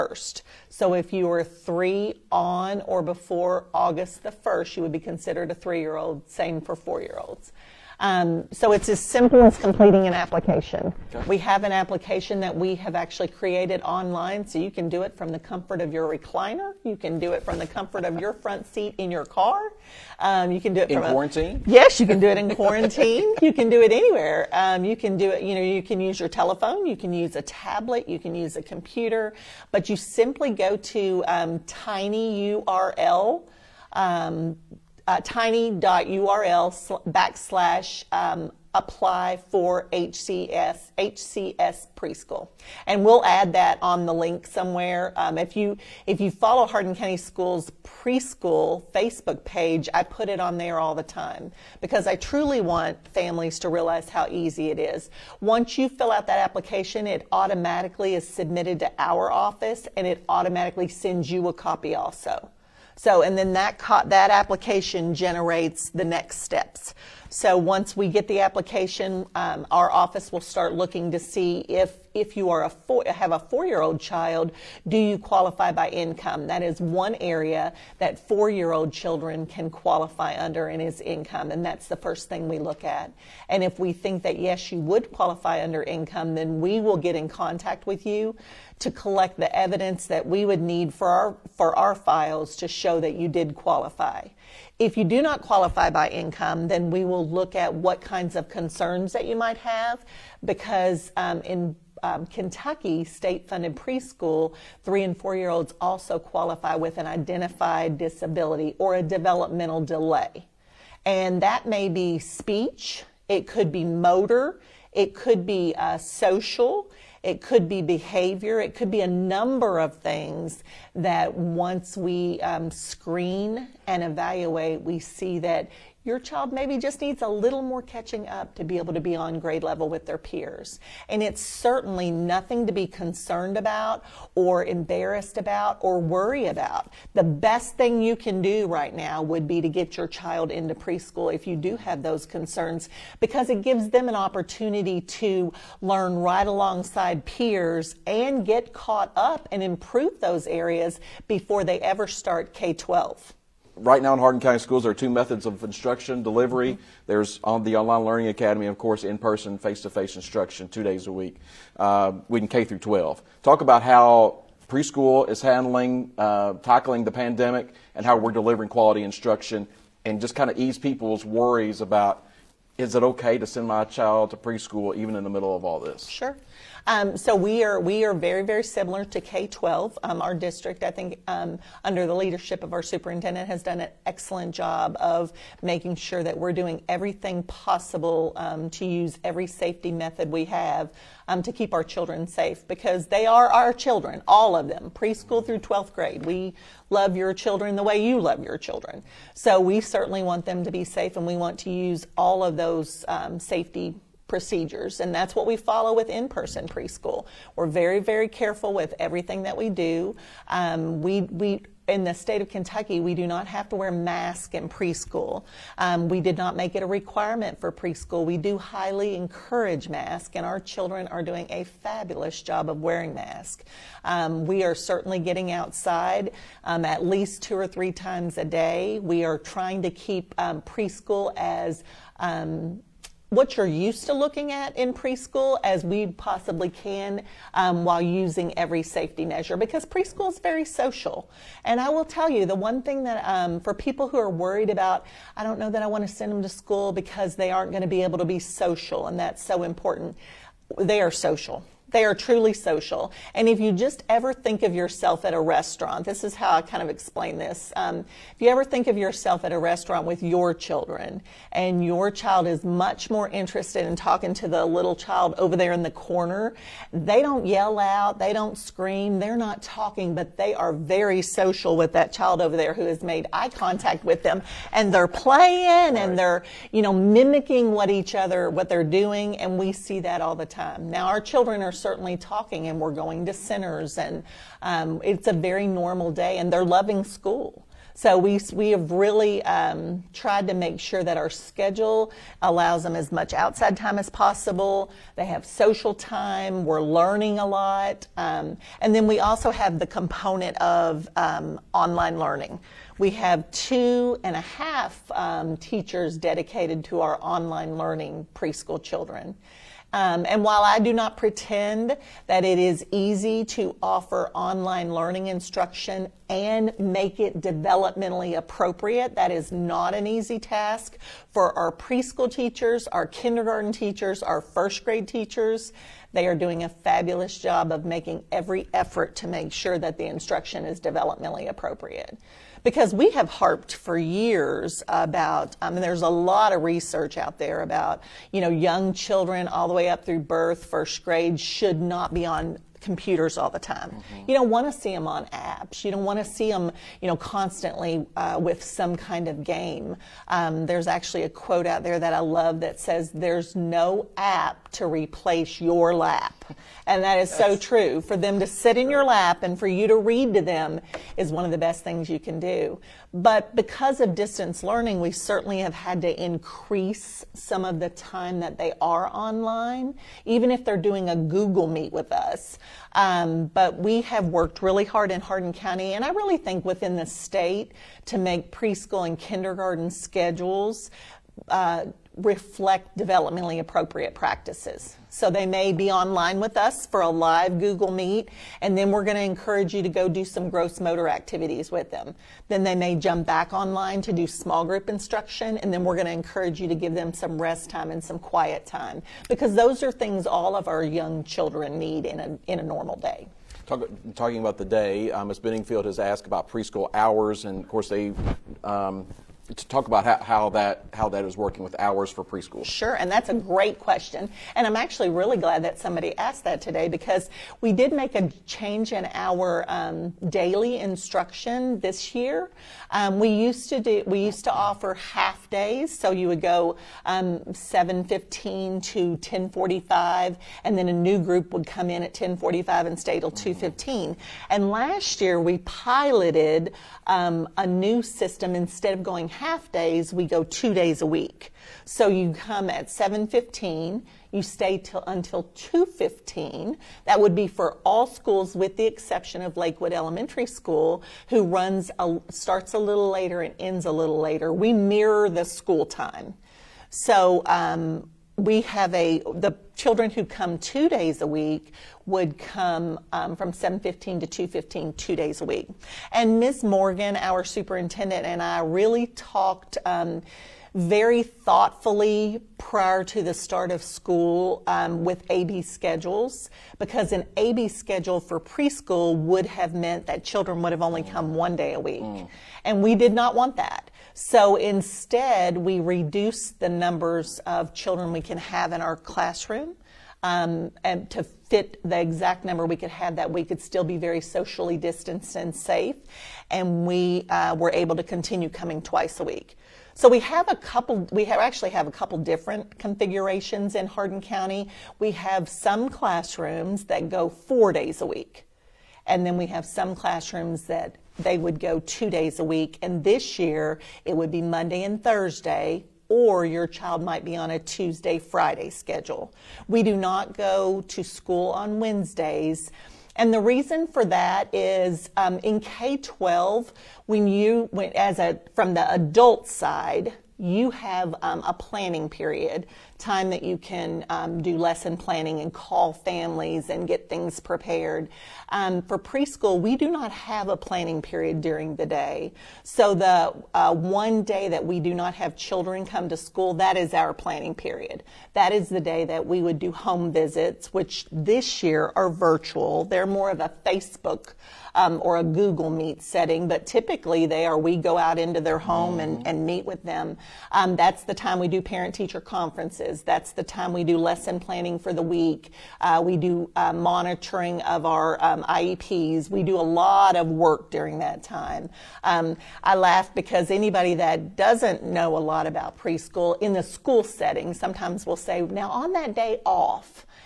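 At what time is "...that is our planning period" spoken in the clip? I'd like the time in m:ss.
9:06.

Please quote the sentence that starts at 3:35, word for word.
Um, we did not make it a requirement for preschool.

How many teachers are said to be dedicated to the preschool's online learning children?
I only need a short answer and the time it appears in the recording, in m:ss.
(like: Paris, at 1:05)
2.5, at 5:03.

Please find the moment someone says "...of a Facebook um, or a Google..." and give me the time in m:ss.
9:13.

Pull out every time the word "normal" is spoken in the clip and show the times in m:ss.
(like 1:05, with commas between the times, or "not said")
4:45, 6:42.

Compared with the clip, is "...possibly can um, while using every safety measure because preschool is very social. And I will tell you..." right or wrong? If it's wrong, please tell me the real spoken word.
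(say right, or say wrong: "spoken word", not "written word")
right.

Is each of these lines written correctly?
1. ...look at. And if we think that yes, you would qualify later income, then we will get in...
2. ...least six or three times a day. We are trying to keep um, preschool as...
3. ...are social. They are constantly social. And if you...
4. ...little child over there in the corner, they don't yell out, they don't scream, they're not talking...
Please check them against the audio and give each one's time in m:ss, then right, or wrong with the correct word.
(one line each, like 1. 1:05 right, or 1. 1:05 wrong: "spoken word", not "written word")
1. 1:22 wrong: "under", not "later"
2. 3:47 wrong: "two", not "six"
3. 4:11 wrong: "truly", not "constantly"
4. 4:24 right.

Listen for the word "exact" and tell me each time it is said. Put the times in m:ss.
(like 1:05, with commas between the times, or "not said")
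8:12.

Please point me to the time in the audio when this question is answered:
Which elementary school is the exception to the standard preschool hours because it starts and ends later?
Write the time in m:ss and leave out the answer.
7:29.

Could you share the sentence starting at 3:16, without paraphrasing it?
We love your children the way you love your children.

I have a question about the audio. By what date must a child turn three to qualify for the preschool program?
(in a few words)
August 1st.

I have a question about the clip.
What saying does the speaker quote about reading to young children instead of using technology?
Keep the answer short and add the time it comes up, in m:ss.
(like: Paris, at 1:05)
There's no app to replace your lap, at 5:53.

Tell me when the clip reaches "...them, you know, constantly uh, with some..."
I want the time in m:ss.
5:46.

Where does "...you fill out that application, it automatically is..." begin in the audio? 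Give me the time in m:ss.
0:55.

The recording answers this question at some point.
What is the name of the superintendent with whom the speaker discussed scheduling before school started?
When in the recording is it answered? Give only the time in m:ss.
7:46.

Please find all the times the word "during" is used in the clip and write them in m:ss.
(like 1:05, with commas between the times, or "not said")
9:01, 9:30.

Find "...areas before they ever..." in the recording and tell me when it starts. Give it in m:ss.
2:30.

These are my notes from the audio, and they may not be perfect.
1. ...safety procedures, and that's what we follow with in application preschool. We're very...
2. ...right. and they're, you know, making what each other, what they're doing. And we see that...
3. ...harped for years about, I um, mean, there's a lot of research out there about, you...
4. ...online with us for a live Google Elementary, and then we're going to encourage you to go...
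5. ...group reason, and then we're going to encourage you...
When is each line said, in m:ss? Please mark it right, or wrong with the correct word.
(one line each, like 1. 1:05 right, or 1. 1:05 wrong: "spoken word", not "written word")
1. 3:23 wrong: "person", not "application"
2. 4:35 wrong: "mimicking", not "making"
3. 5:33 right
4. 6:25 wrong: "Meet", not "Elementary"
5. 6:34 wrong: "instruction", not "reason".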